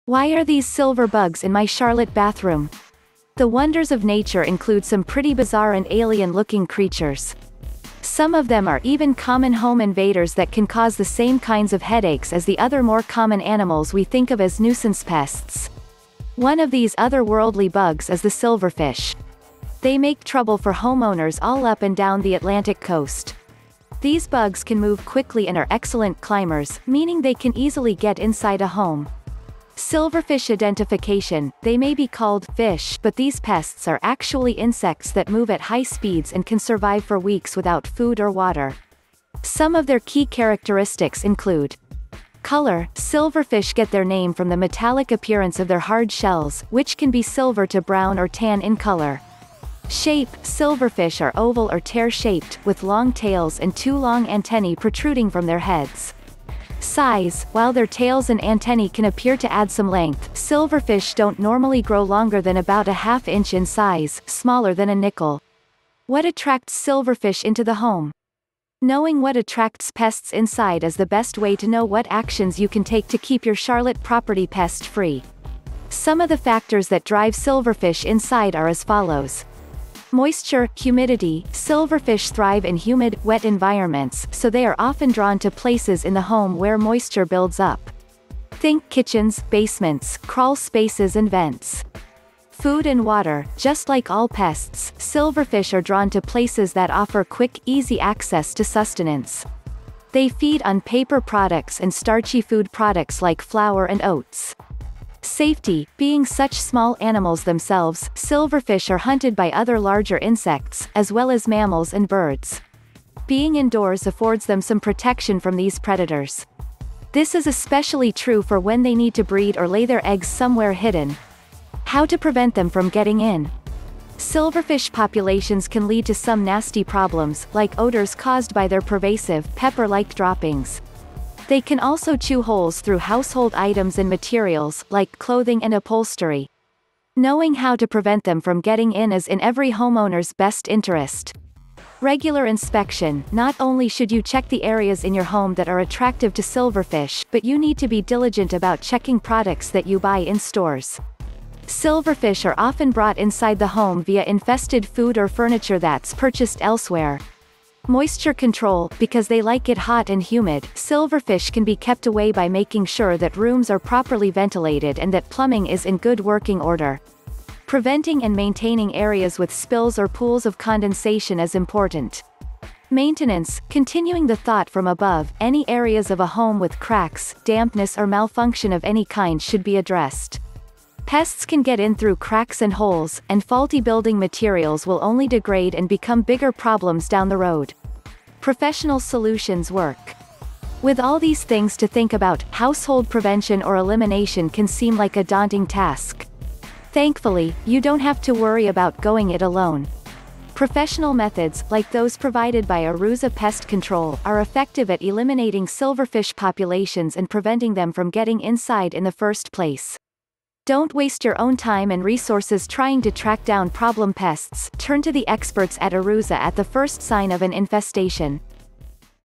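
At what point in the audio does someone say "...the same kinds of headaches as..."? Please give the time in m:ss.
0:10.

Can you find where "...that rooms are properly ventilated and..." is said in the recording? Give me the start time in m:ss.
2:43.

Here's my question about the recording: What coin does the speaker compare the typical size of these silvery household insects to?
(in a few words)
nickel.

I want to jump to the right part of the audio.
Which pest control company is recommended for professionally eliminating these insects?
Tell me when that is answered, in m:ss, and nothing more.
3:22.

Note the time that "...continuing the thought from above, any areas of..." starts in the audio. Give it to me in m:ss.
2:53.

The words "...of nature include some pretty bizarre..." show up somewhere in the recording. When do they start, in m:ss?
0:03.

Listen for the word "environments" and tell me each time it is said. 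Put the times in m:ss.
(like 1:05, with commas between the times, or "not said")
1:23.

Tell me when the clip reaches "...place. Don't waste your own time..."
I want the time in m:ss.
3:29.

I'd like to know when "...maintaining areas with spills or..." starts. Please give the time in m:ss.
2:48.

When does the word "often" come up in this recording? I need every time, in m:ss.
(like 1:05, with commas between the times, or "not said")
1:24, 2:32.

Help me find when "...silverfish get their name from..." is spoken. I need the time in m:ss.
0:42.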